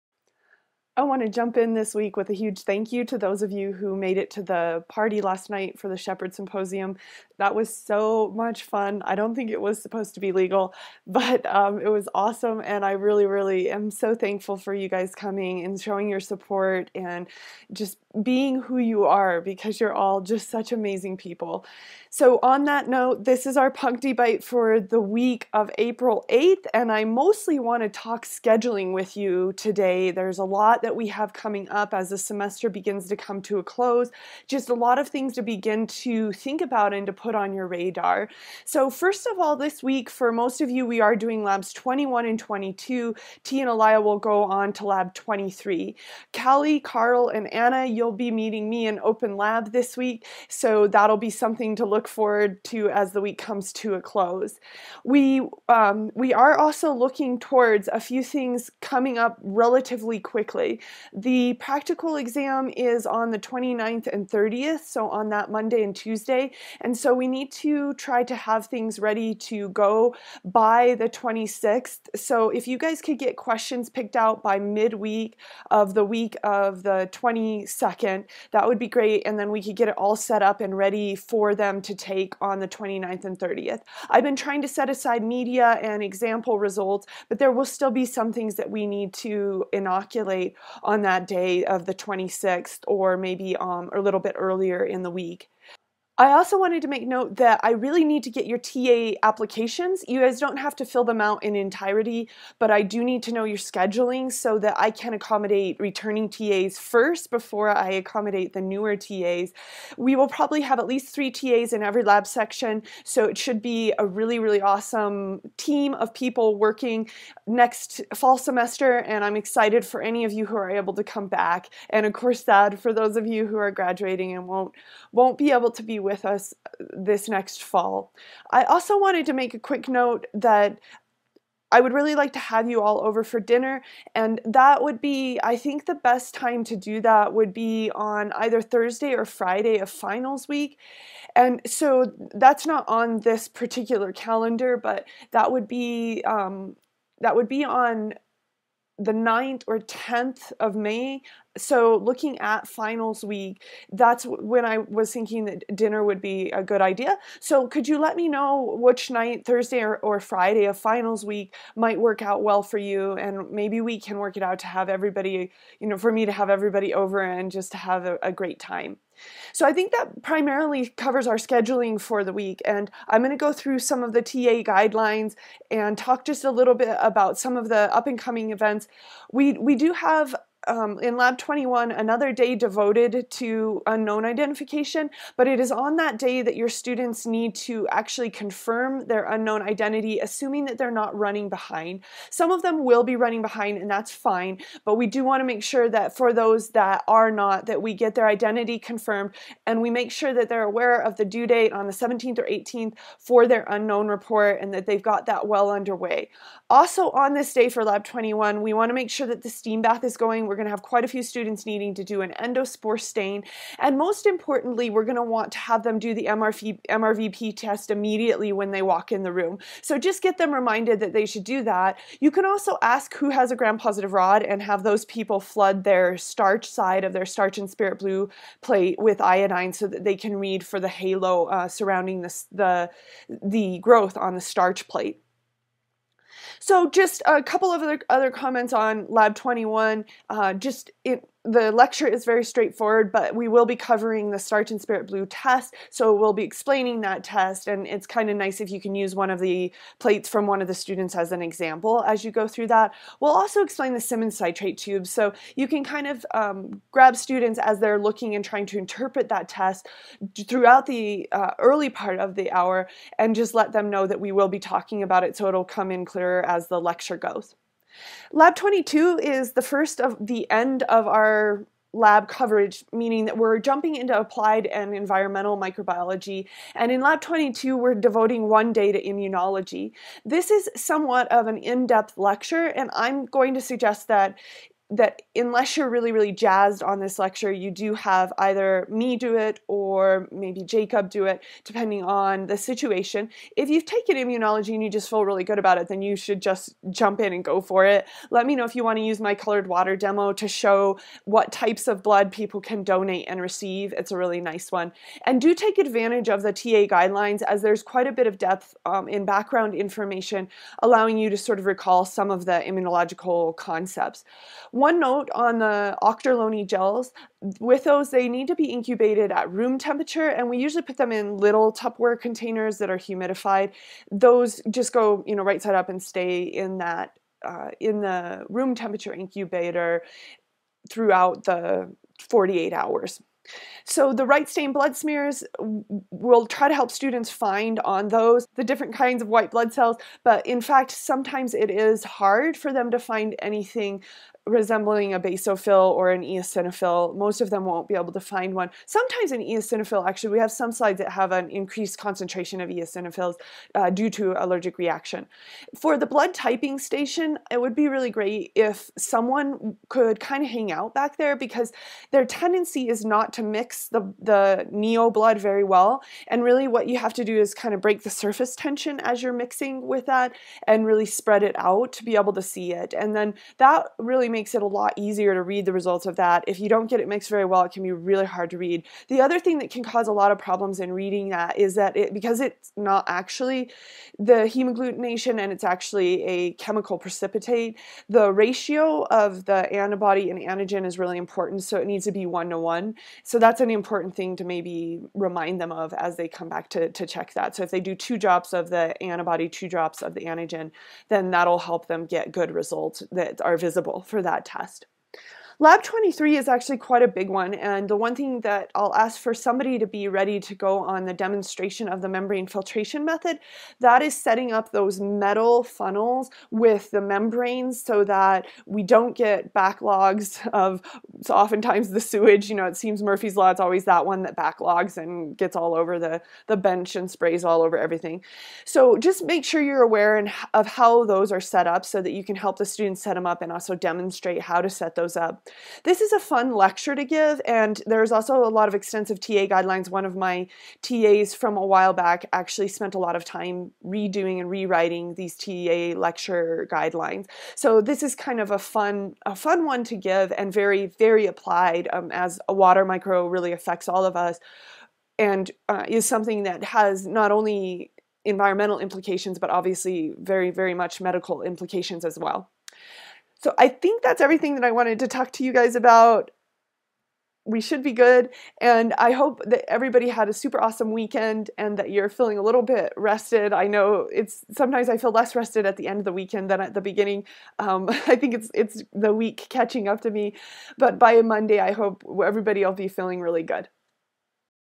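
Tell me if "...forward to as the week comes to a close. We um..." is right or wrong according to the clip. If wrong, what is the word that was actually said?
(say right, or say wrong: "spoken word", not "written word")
right.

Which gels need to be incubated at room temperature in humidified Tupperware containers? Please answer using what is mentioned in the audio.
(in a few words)
Ouchterlony gels.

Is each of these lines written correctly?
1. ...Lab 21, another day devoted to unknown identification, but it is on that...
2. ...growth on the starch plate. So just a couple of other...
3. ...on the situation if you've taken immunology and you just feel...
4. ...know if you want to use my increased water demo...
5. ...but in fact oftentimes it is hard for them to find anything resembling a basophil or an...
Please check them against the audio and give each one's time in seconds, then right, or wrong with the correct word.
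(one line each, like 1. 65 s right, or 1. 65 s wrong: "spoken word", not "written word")
1. 181 s right
2. 233 s right
3. 292 s right
4. 298 s wrong: "colored", not "increased"
5. 340 s wrong: "sometimes", not "oftentimes".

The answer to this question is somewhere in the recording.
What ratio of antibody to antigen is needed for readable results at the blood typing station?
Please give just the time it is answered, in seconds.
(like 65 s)
392 s.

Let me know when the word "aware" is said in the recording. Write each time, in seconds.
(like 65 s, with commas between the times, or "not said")
200 s, 429 s.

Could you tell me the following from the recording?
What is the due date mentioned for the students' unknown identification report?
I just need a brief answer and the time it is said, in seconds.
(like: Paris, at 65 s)
17th or 18th, at 201 s.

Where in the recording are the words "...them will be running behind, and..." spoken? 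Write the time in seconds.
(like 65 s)
192 s.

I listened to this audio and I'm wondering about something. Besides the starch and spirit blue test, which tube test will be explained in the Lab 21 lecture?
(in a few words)
Simmons citrate.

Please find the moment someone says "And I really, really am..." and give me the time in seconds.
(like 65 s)
12 s.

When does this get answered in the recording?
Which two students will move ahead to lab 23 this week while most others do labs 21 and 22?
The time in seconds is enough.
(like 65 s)
43 s.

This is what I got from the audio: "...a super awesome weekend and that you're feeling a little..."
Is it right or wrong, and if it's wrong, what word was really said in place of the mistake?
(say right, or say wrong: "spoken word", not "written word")
right.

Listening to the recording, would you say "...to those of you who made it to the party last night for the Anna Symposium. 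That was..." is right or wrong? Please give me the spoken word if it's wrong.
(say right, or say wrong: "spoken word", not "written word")
wrong: "Shepherd", not "Anna".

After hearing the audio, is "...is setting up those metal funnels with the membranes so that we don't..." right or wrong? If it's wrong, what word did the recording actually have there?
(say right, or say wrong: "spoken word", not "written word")
right.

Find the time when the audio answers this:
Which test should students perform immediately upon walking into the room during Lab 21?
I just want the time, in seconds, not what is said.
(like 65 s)
216 s.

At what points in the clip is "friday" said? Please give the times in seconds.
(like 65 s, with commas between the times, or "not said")
139 s, 160 s.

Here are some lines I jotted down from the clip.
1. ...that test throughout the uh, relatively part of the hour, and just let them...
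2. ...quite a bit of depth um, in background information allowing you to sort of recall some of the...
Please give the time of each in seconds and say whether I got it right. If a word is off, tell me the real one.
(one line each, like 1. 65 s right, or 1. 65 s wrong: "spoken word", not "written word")
1. 259 s wrong: "early", not "relatively"
2. 307 s right.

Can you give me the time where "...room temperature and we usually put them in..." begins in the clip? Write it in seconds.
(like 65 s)
319 s.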